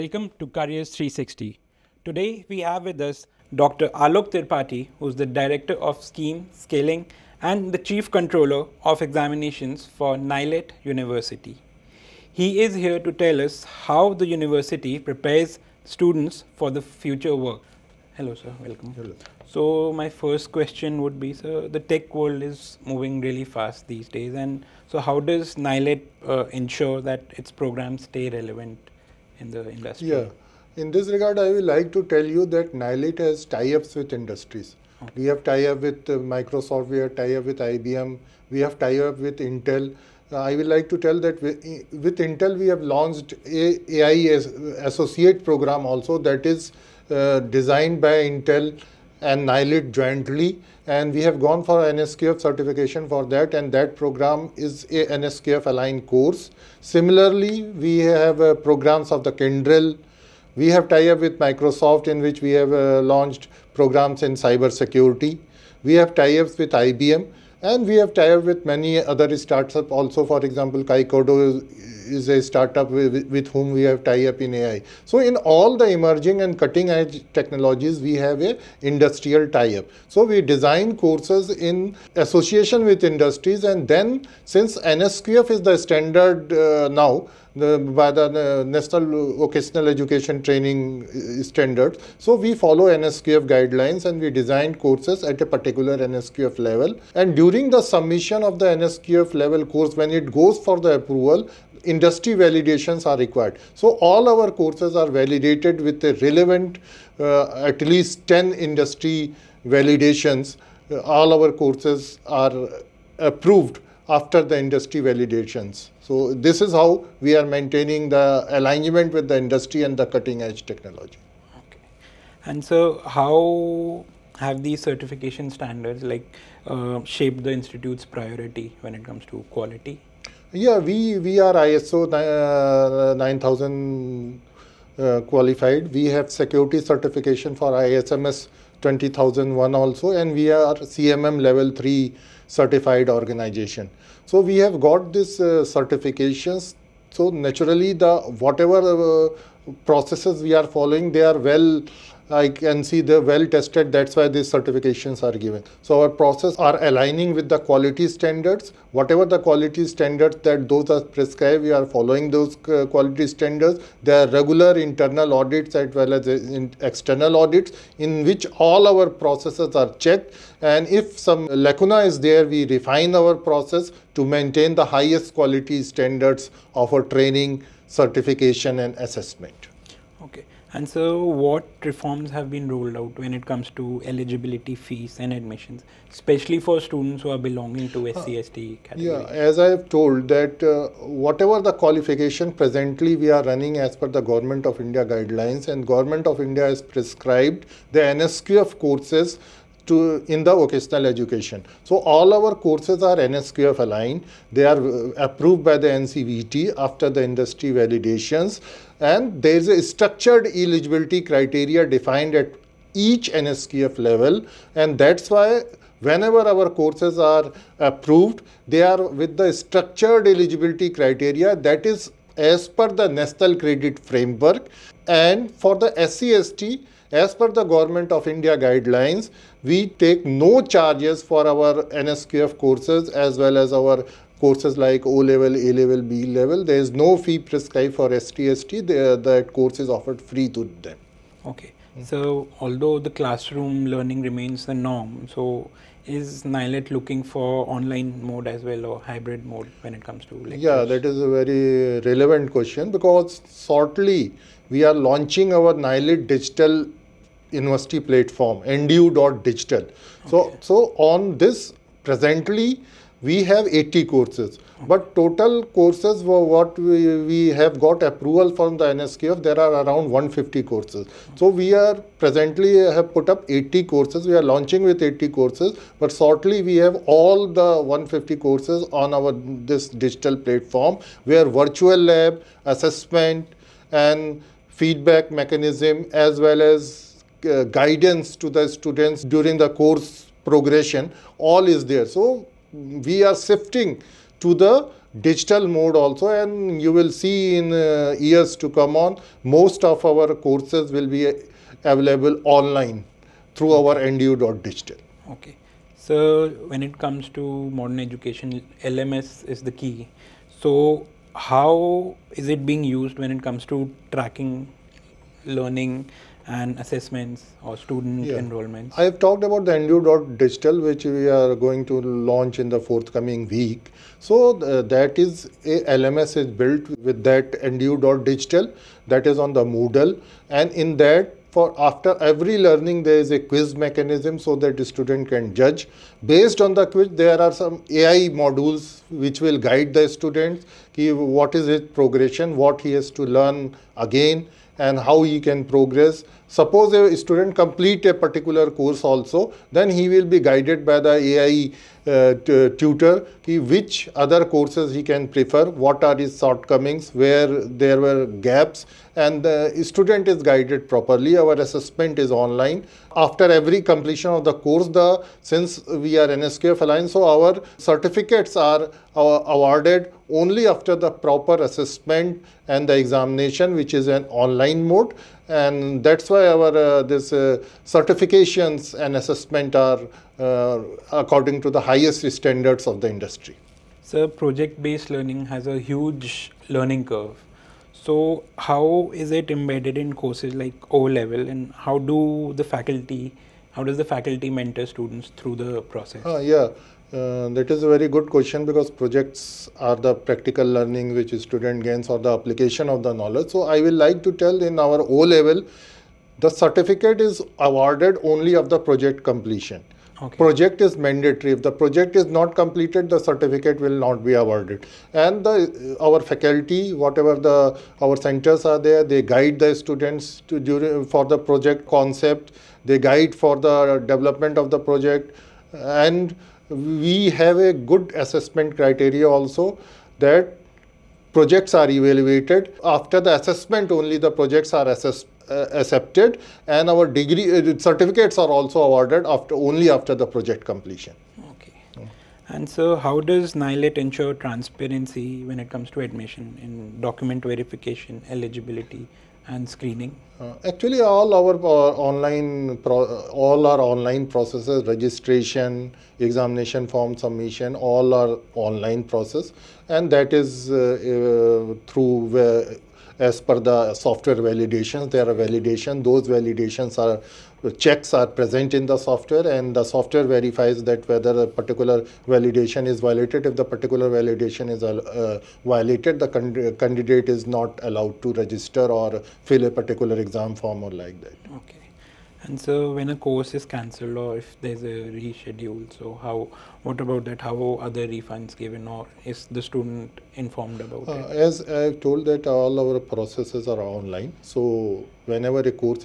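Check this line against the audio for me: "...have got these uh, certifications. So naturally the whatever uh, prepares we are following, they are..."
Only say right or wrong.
wrong.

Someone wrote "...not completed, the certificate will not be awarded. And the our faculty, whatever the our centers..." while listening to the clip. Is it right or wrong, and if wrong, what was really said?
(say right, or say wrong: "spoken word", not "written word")
right.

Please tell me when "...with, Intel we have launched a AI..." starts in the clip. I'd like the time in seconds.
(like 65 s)
41 s.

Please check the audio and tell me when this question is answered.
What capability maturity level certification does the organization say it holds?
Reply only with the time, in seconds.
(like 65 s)
140 s.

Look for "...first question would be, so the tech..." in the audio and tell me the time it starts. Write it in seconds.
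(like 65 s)
20 s.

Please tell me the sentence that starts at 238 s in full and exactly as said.
The, that course is offered free to them.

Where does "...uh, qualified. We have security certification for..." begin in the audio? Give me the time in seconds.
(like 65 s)
134 s.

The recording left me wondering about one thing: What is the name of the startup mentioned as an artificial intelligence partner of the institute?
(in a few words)
Kaikodo.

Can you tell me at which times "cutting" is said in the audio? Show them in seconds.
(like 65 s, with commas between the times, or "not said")
76 s, 120 s.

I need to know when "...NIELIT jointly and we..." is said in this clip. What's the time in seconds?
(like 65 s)
49 s.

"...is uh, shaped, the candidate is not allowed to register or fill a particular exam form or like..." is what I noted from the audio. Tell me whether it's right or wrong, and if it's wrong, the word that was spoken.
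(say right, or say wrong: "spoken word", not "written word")
wrong: "violated", not "shaped".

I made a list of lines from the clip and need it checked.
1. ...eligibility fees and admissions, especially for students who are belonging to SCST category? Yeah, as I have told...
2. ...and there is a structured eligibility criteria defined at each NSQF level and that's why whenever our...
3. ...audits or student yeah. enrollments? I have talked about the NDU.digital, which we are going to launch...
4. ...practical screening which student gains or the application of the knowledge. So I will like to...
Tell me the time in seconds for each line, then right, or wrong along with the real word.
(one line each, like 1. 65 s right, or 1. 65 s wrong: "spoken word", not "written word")
1. 184 s right
2. 209 s right
3. 316 s wrong: "assessments", not "audits"
4. 400 s wrong: "learning", not "screening".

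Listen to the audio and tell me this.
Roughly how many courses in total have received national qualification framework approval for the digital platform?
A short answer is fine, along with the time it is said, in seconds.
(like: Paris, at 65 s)
150, at 269 s.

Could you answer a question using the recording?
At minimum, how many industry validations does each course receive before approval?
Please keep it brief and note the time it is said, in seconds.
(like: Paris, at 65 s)
10, at 107 s.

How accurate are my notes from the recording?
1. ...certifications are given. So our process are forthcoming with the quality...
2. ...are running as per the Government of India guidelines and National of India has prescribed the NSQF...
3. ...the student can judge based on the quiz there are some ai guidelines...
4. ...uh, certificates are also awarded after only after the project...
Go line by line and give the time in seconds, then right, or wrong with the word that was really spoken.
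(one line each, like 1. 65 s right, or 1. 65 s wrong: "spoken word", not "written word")
1. 154 s wrong: "aligning", not "forthcoming"
2. 193 s wrong: "Government", not "National"
3. 334 s wrong: "modules", not "guidelines"
4. 437 s right.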